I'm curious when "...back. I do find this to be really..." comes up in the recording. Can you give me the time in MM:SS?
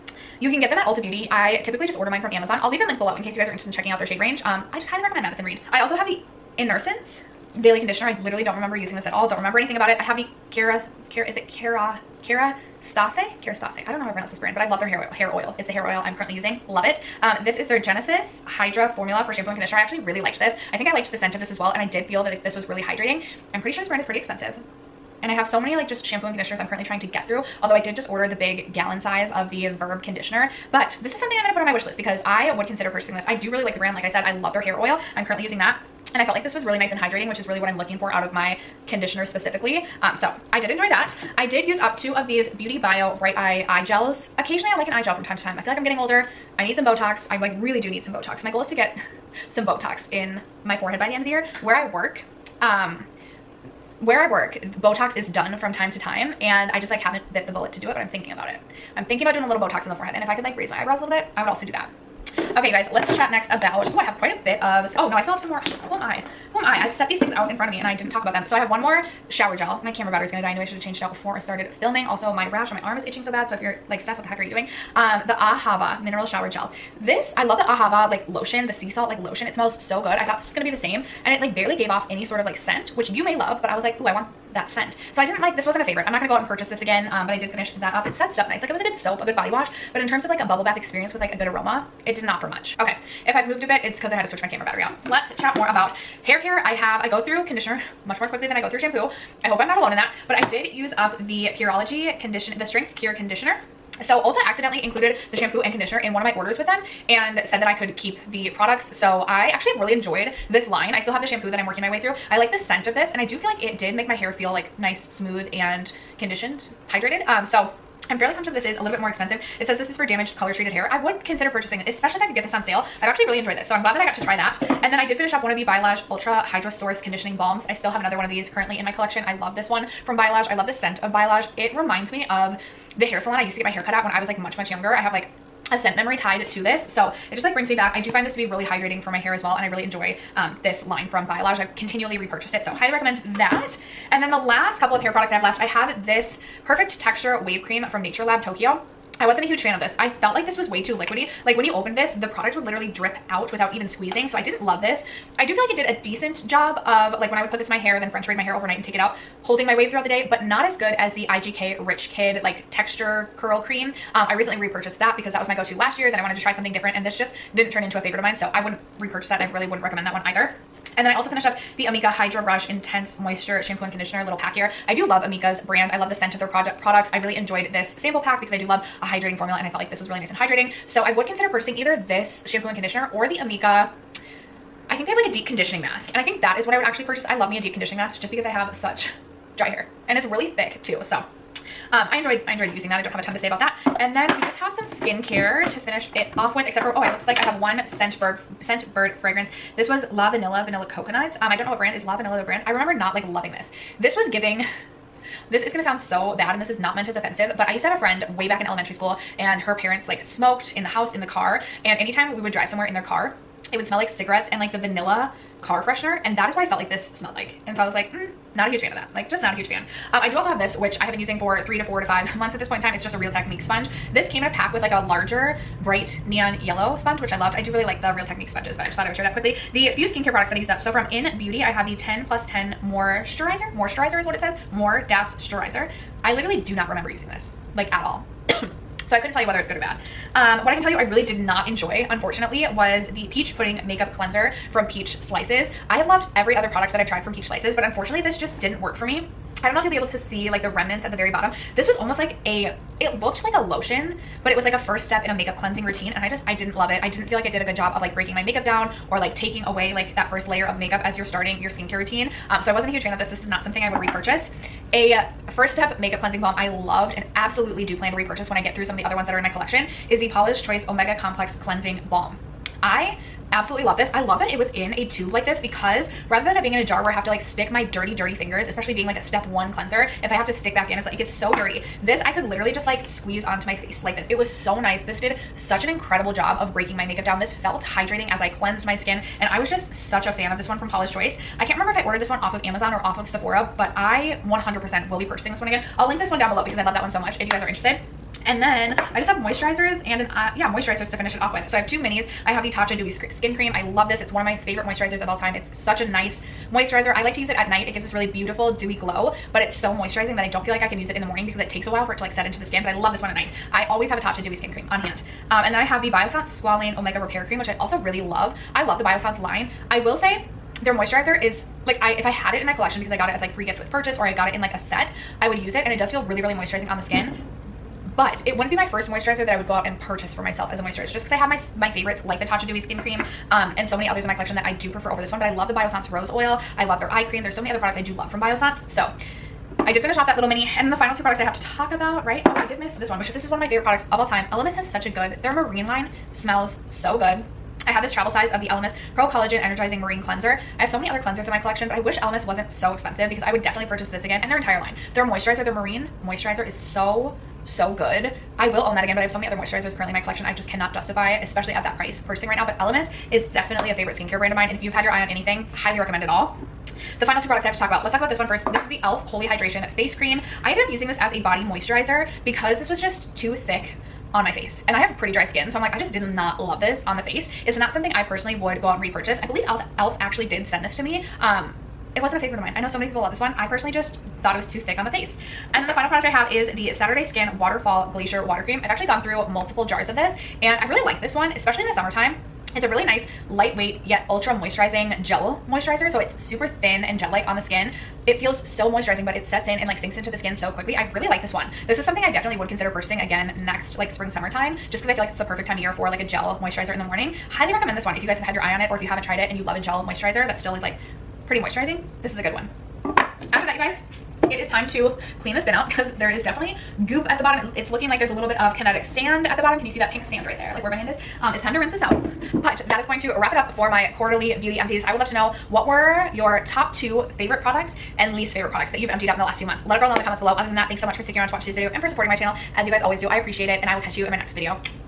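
02:17.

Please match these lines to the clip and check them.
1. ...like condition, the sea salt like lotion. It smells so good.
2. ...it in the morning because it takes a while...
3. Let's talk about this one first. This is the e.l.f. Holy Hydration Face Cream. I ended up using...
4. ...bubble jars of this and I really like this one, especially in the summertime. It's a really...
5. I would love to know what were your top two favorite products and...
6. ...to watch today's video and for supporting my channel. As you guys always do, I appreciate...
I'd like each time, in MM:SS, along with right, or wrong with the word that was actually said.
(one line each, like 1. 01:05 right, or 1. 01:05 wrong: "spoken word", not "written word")
1. 01:18 wrong: "lotion", not "condition"
2. 05:11 right
3. 06:08 right
4. 06:29 wrong: "multiple", not "bubble"
5. 07:05 right
6. 07:11 right.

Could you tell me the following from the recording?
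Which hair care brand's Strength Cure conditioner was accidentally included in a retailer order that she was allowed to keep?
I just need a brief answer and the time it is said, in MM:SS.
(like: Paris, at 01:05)
Pureology, at 01:41.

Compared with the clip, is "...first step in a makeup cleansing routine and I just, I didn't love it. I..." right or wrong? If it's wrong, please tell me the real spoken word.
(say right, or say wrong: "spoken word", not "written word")
right.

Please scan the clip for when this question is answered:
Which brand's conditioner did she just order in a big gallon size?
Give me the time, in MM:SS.
00:29.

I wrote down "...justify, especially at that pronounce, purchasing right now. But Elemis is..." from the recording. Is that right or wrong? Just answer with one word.
wrong.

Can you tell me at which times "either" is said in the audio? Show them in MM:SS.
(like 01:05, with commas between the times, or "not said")
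02:50, 03:01.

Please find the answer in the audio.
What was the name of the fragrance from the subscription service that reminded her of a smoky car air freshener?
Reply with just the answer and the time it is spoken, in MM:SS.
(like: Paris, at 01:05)
Vanilla Coconut, at 03:20.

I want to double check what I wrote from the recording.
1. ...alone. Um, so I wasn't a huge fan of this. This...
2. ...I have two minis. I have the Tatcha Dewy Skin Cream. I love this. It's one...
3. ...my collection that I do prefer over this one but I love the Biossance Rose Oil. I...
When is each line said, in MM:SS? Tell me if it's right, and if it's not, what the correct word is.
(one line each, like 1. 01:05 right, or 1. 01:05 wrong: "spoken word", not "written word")
1. 04:21 wrong: "routine", not "alone"
2. 05:01 right
3. 05:34 right.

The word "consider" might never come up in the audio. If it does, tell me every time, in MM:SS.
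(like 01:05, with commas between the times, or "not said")
00:32, 02:01, 03:01, 06:42.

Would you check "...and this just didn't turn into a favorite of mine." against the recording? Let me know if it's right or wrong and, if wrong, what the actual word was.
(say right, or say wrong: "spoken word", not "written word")
right.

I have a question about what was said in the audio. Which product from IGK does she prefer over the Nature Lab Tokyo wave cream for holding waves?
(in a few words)
Rich Kid.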